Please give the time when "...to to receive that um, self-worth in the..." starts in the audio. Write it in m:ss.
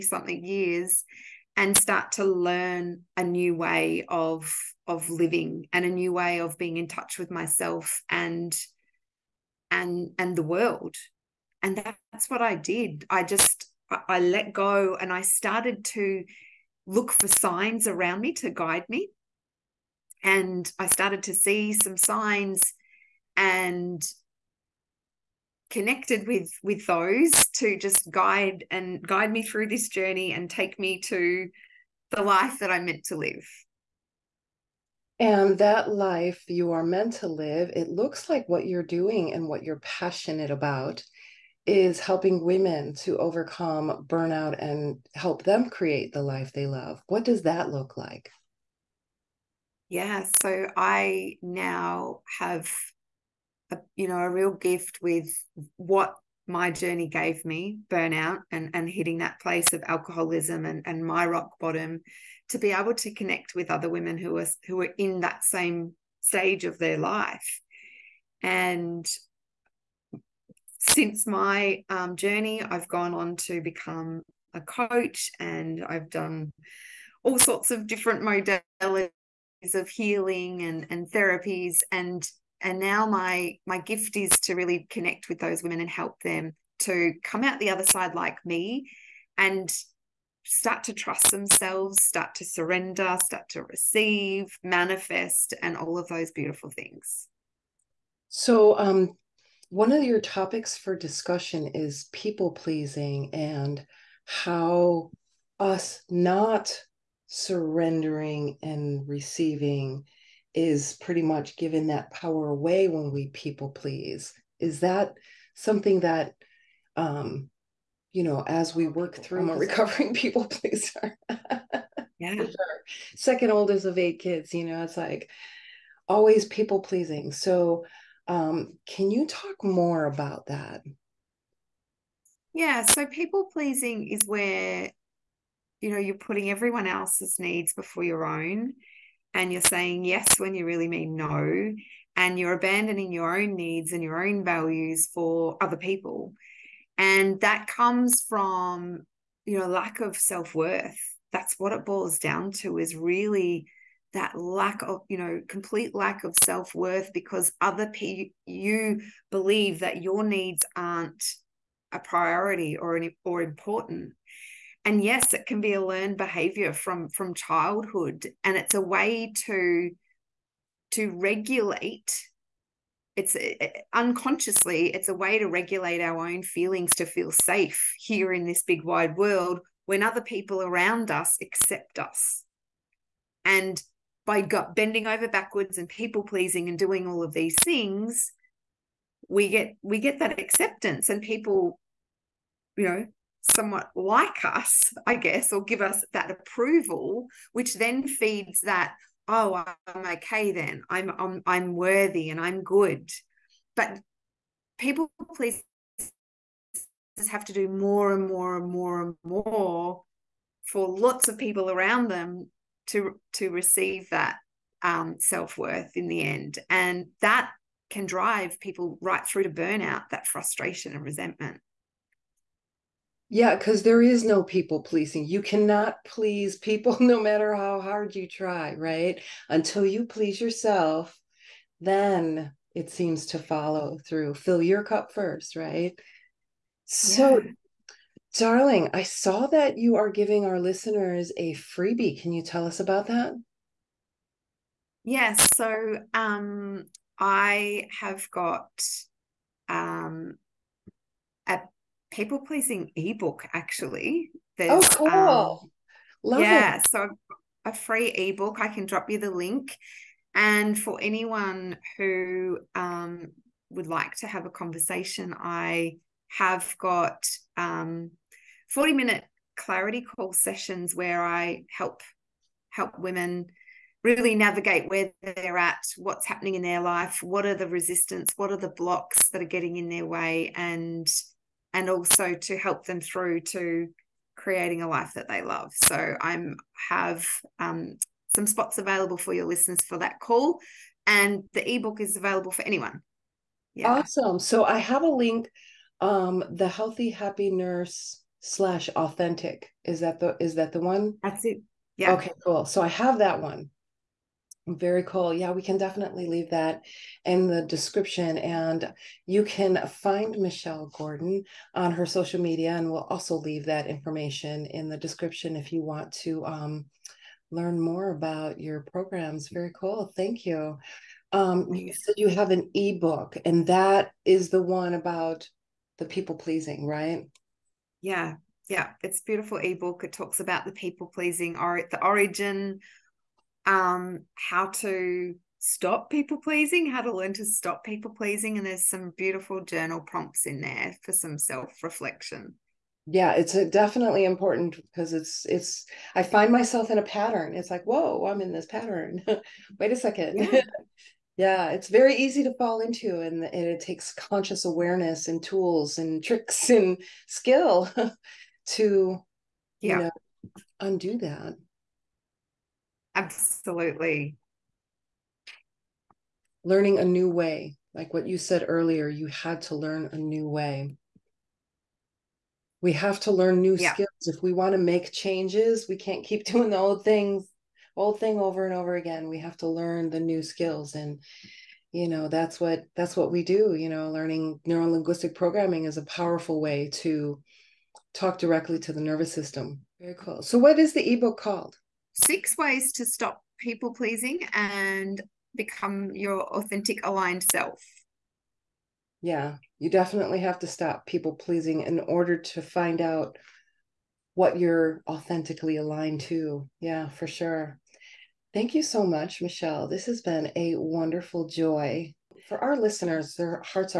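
3:32.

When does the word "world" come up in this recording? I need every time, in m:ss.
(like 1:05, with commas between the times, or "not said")
0:10, 2:59.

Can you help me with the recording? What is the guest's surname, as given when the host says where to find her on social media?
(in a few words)
Gordon.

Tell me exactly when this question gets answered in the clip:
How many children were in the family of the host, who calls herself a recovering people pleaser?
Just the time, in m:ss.
2:03.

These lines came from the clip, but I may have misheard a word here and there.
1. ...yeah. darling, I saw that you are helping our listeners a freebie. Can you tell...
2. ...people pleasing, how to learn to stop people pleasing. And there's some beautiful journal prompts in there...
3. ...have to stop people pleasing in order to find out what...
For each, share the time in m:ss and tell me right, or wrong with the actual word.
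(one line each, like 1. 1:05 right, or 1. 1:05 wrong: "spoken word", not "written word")
1. 3:57 wrong: "giving", not "helping"
2. 5:36 right
3. 6:40 right.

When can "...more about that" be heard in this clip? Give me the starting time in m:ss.
2:09.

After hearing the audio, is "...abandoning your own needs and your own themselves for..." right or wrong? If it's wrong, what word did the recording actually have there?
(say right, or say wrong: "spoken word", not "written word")
wrong: "values", not "themselves".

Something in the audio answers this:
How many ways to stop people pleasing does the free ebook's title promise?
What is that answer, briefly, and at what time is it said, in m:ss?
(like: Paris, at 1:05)
6, at 6:32.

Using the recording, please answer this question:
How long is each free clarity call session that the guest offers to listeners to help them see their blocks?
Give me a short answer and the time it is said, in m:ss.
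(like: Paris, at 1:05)
40 minutes, at 4:28.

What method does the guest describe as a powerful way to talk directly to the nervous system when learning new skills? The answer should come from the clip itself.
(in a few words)
neuro linguistic programming.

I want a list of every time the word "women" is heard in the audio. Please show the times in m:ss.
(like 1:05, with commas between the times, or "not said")
0:42, 1:03, 1:25, 4:32.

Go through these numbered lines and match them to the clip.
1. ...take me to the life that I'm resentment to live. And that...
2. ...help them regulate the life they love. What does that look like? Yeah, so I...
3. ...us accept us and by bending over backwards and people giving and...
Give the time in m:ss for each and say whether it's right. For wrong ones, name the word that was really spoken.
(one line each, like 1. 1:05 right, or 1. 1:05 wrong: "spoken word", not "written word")
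1. 0:30 wrong: "meant", not "resentment"
2. 0:45 wrong: "create", not "regulate"
3. 3:01 wrong: "pleasing", not "giving".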